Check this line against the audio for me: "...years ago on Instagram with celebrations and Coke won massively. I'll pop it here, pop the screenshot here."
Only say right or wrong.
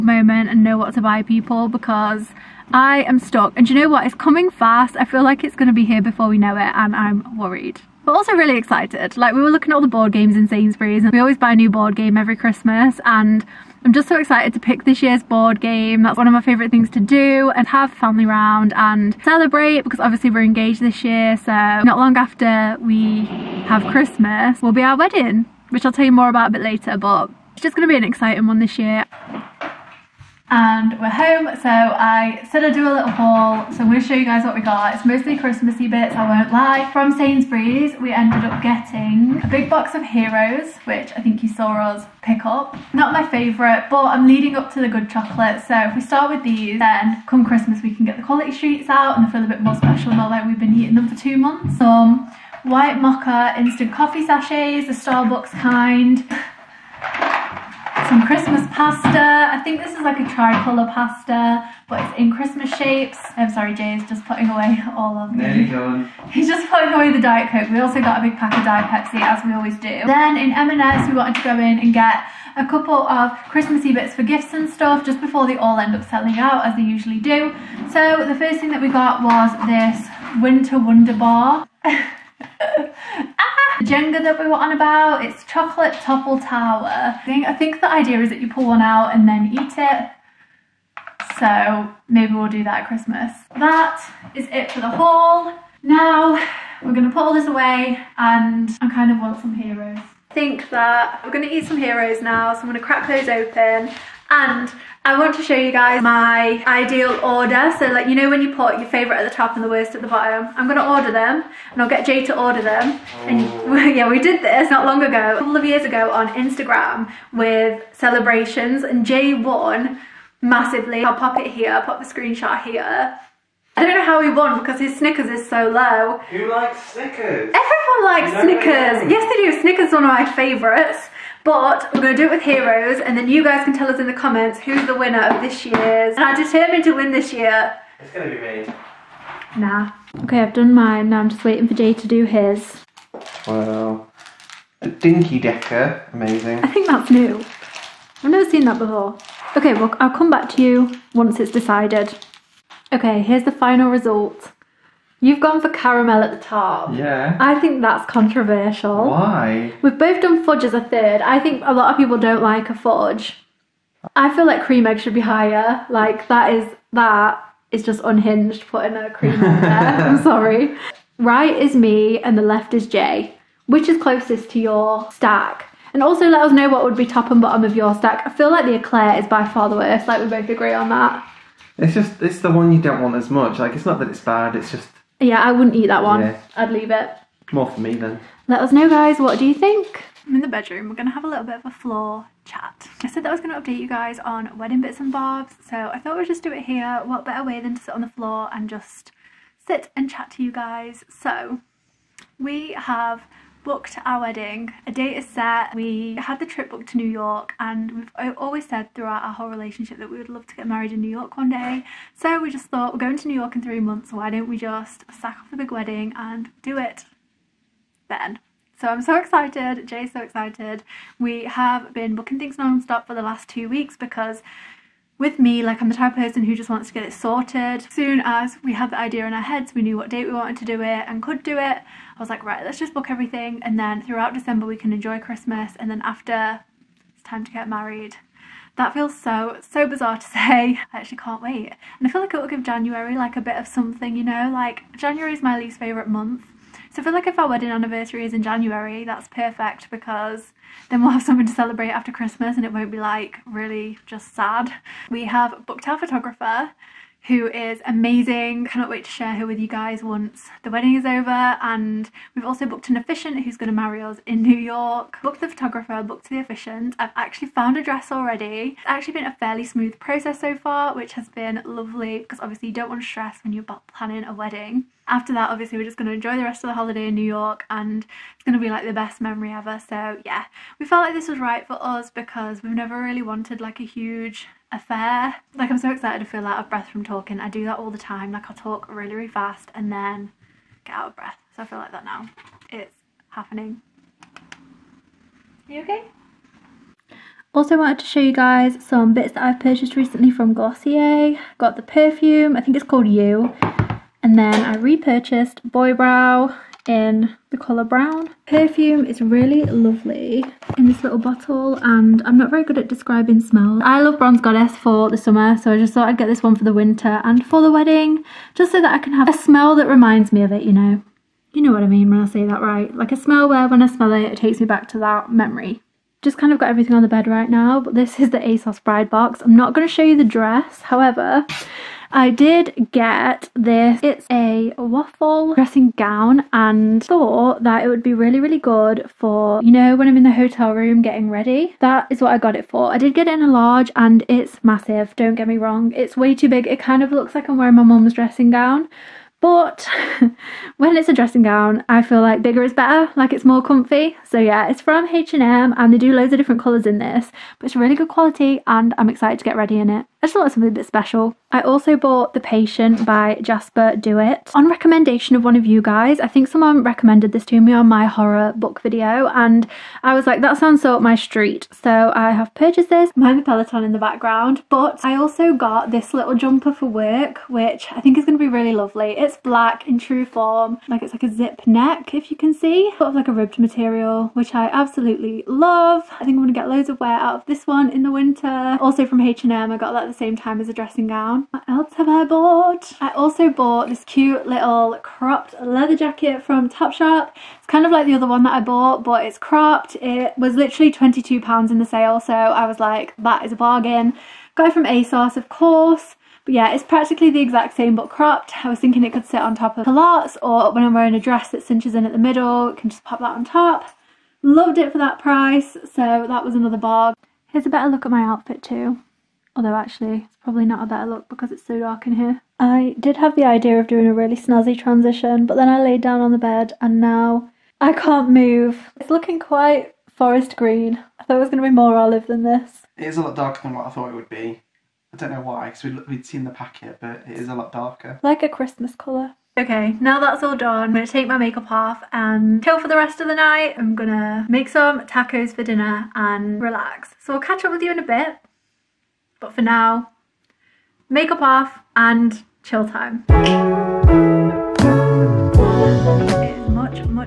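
wrong.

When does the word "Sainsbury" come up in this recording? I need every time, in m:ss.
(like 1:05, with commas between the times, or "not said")
0:10, 0:37.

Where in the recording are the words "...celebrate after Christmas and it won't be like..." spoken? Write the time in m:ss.
4:11.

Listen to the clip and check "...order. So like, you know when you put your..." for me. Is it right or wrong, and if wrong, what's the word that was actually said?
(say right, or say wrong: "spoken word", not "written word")
right.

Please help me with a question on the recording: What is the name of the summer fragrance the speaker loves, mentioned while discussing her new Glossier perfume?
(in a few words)
Bronze Goddess.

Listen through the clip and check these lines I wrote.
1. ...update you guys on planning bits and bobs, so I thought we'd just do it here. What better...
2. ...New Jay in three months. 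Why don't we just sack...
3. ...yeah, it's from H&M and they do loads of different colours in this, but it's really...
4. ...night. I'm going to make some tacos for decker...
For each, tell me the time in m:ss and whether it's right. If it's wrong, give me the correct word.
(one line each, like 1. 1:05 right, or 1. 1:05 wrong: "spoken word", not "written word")
1. 3:13 wrong: "wedding", not "planning"
2. 3:33 wrong: "York", not "Jay"
3. 5:54 right
4. 7:23 wrong: "dinner", not "decker".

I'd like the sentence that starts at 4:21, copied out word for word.
And we've also booked an officiant who's going to marry us in New York.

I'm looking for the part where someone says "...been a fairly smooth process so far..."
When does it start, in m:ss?
4:29.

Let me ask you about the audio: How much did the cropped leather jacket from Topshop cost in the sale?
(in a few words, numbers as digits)
£22.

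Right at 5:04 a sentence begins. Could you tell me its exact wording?
And then I repurchased Boy Brow in the colour brown.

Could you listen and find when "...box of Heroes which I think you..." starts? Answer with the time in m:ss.
0:39.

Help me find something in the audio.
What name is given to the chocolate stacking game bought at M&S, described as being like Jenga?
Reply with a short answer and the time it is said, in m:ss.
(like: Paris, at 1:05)
chocolate topple tower, at 1:25.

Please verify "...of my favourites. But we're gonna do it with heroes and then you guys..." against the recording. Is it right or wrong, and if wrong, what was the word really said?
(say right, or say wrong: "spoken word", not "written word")
right.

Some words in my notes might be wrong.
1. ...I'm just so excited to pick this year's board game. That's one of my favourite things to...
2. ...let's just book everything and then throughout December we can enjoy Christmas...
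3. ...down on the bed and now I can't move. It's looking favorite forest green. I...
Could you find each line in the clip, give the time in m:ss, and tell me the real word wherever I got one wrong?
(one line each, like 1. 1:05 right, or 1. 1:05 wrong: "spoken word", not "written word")
1. 0:13 right
2. 3:52 right
3. 7:06 wrong: "quite", not "favorite".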